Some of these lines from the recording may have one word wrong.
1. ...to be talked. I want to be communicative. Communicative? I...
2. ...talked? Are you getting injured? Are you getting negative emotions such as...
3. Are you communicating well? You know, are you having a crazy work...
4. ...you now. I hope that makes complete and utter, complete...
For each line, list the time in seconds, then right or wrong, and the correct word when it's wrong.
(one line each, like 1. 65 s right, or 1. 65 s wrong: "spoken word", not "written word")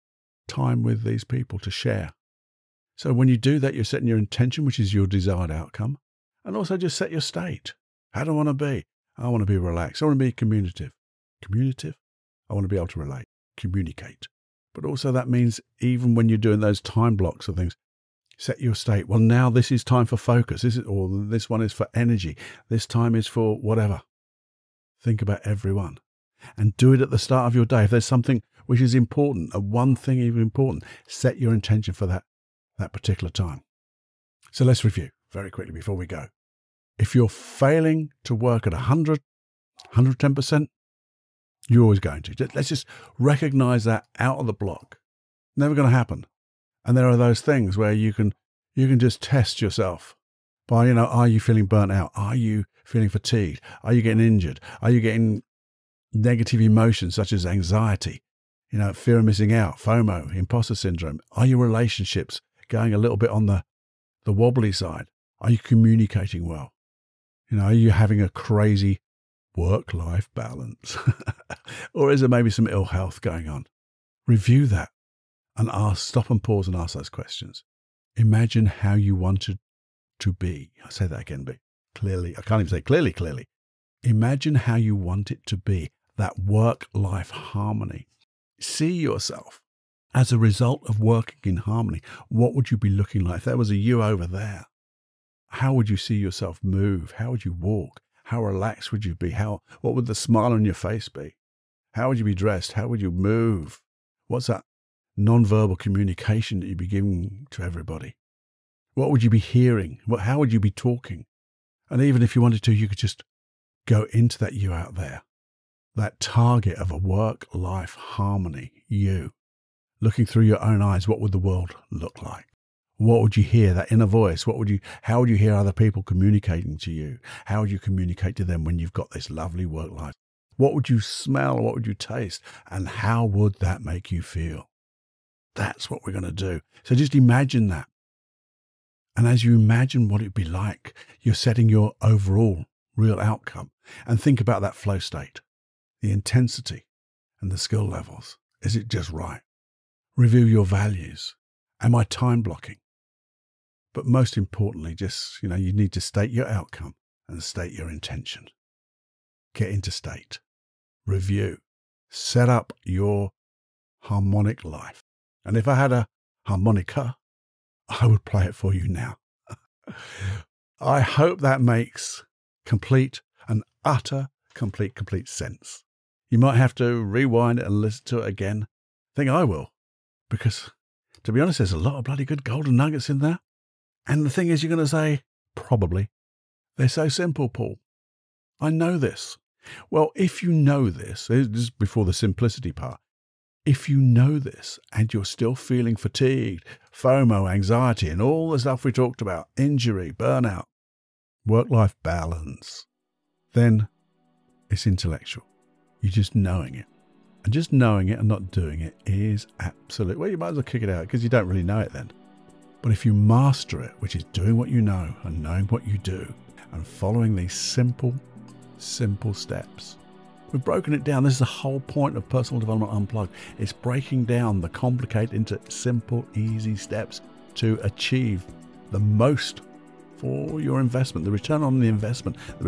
1. 9 s wrong: "relaxed", not "talked"
2. 53 s wrong: "fatigued", not "talked"
3. 65 s right
4. 168 s right.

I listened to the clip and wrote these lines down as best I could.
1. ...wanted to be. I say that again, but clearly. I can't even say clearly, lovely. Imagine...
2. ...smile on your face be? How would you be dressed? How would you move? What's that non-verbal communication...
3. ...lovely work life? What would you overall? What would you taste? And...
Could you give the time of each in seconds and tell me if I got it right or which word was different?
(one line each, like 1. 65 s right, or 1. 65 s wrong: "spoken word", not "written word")
1. 79 s wrong: "clearly", not "lovely"
2. 100 s right
3. 129 s wrong: "smell", not "overall".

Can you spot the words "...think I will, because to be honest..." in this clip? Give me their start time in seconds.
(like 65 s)
179 s.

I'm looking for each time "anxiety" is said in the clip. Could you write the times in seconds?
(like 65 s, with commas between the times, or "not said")
57 s, 197 s.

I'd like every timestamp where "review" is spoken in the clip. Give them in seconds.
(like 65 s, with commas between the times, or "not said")
34 s, 74 s, 150 s, 161 s.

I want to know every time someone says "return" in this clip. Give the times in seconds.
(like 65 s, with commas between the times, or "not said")
231 s.